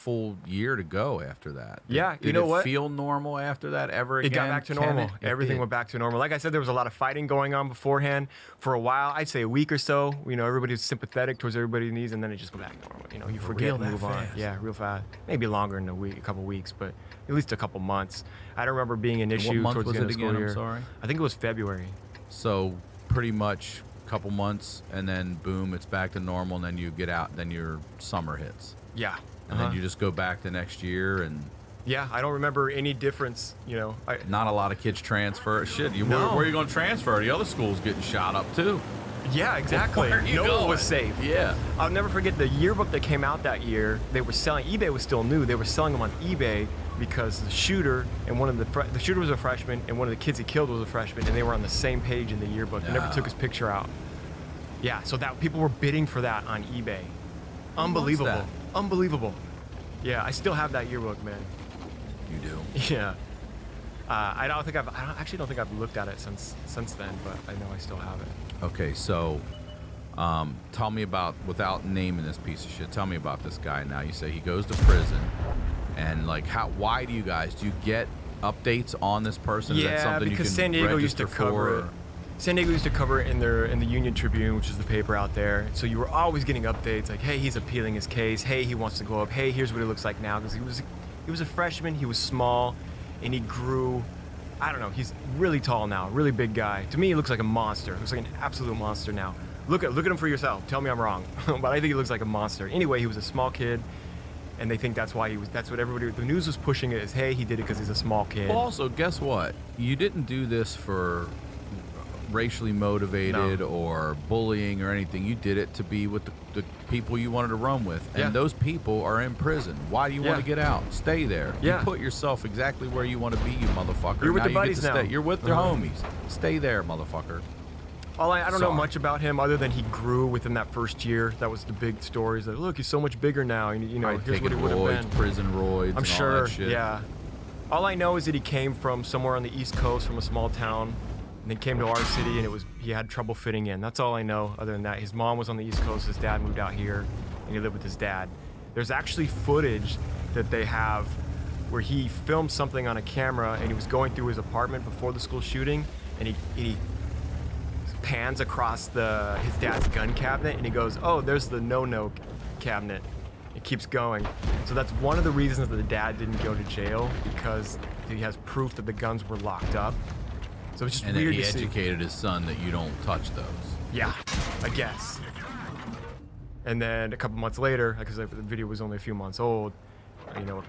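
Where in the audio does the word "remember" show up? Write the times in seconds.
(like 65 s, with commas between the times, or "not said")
18 s, 32 s.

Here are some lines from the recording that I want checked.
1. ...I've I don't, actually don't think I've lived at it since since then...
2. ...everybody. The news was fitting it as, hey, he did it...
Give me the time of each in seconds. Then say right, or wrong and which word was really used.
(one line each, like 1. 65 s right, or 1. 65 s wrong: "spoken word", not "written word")
1. 64 s wrong: "looked", not "lived"
2. 105 s wrong: "pushing", not "fitting".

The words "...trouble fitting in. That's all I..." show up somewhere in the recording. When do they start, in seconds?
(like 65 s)
143 s.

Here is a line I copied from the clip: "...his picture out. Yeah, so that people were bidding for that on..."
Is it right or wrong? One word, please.
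right.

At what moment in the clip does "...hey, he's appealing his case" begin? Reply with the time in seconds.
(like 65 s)
87 s.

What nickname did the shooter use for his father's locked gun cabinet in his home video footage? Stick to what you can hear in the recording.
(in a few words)
no-no cabinet.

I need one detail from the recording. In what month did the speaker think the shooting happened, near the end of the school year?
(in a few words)
February.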